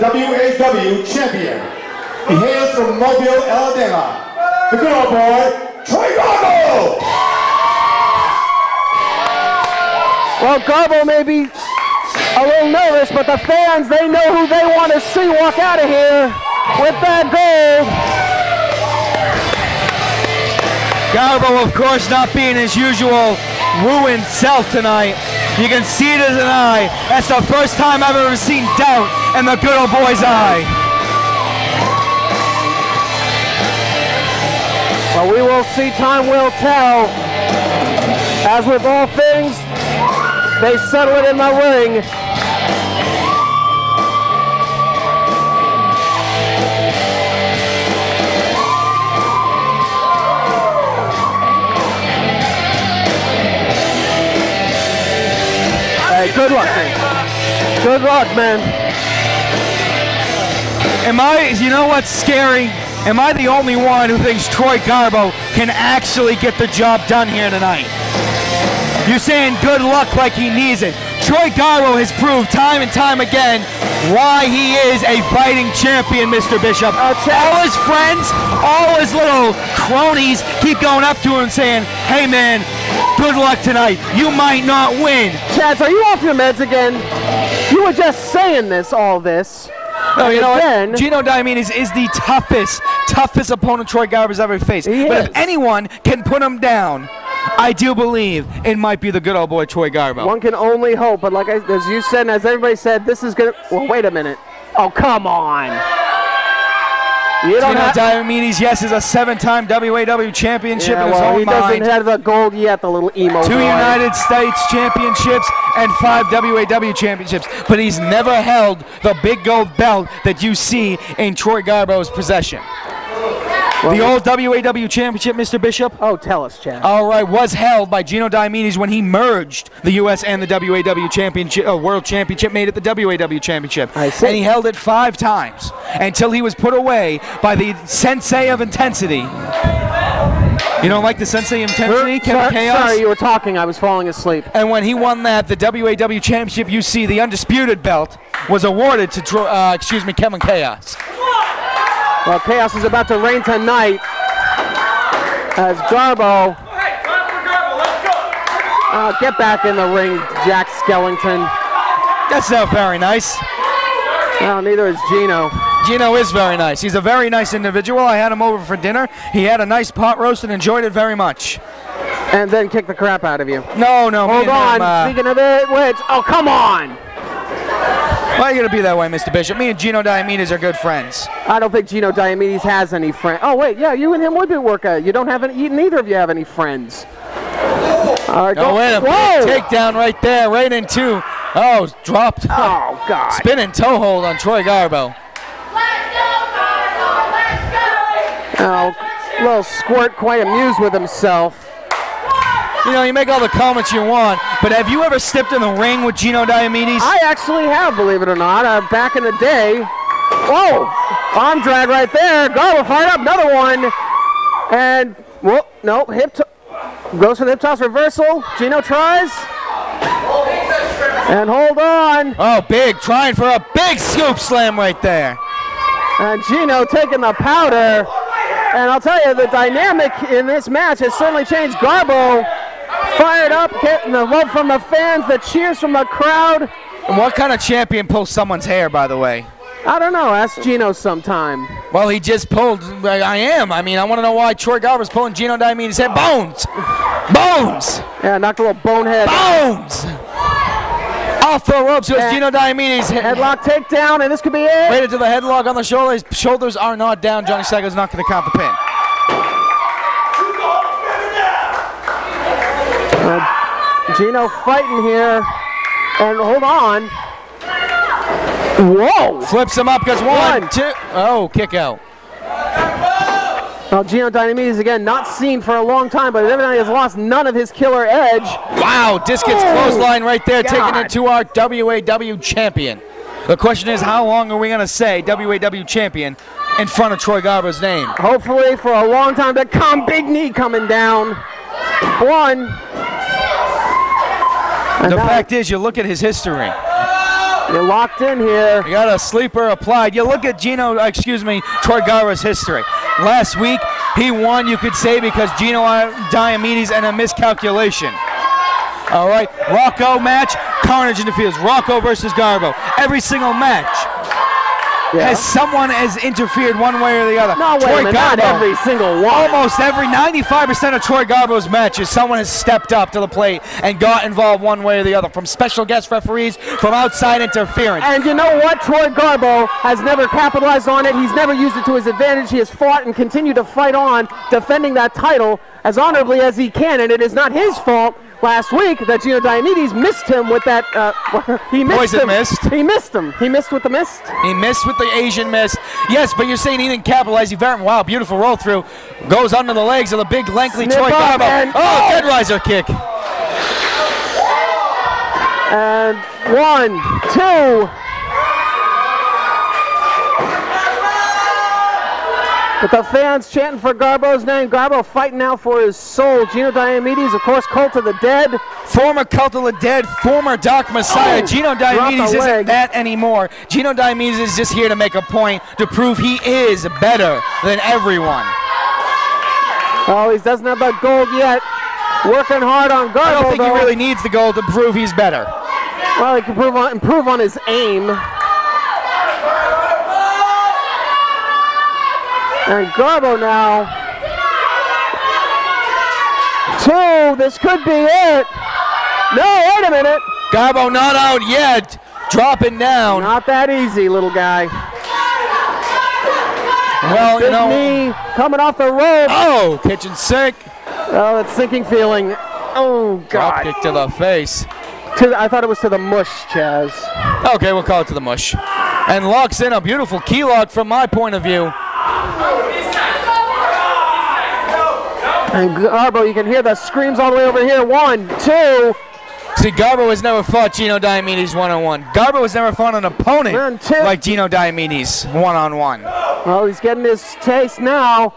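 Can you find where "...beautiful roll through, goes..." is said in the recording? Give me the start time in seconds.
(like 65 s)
348 s.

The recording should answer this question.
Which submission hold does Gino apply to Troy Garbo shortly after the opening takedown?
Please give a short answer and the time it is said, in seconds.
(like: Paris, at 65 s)
Spinning toe hold, at 193 s.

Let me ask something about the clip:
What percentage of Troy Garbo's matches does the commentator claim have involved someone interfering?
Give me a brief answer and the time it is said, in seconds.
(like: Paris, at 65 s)
95%, at 320 s.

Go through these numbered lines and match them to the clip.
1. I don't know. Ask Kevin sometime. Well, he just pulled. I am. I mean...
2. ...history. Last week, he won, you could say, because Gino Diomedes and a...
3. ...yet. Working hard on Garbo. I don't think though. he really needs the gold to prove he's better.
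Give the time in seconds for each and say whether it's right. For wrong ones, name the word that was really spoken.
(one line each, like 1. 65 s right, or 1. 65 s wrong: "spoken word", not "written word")
1. 239 s wrong: "Gino", not "Kevin"
2. 302 s right
3. 381 s right.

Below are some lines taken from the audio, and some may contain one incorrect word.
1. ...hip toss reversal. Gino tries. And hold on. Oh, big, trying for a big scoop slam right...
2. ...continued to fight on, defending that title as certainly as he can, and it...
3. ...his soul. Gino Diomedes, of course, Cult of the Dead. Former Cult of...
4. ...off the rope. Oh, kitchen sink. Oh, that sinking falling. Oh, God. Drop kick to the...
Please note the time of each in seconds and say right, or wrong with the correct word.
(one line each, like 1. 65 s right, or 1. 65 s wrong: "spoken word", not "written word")
1. 217 s right
2. 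333 s wrong: "honorably", not "certainly"
3. 365 s right
4. 408 s wrong: "feeling", not "falling".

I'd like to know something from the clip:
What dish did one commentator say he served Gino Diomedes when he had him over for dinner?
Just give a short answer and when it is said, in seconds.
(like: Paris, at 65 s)
Pot roast, at 169 s.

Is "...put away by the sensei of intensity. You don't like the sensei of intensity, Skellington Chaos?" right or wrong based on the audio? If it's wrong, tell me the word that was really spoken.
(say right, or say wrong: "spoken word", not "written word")
wrong: "Kevin", not "Skellington".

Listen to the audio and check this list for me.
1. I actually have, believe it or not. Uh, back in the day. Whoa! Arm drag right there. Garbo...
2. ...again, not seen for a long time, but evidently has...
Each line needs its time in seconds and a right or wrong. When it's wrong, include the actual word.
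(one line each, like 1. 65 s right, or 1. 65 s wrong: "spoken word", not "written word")
1. 207 s right
2. 274 s right.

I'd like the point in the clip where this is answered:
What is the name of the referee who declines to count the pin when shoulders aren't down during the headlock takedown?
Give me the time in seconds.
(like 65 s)
257 s.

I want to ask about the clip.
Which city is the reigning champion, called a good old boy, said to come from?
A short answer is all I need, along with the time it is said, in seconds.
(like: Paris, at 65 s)
Mobile, Alabama, at 2 s.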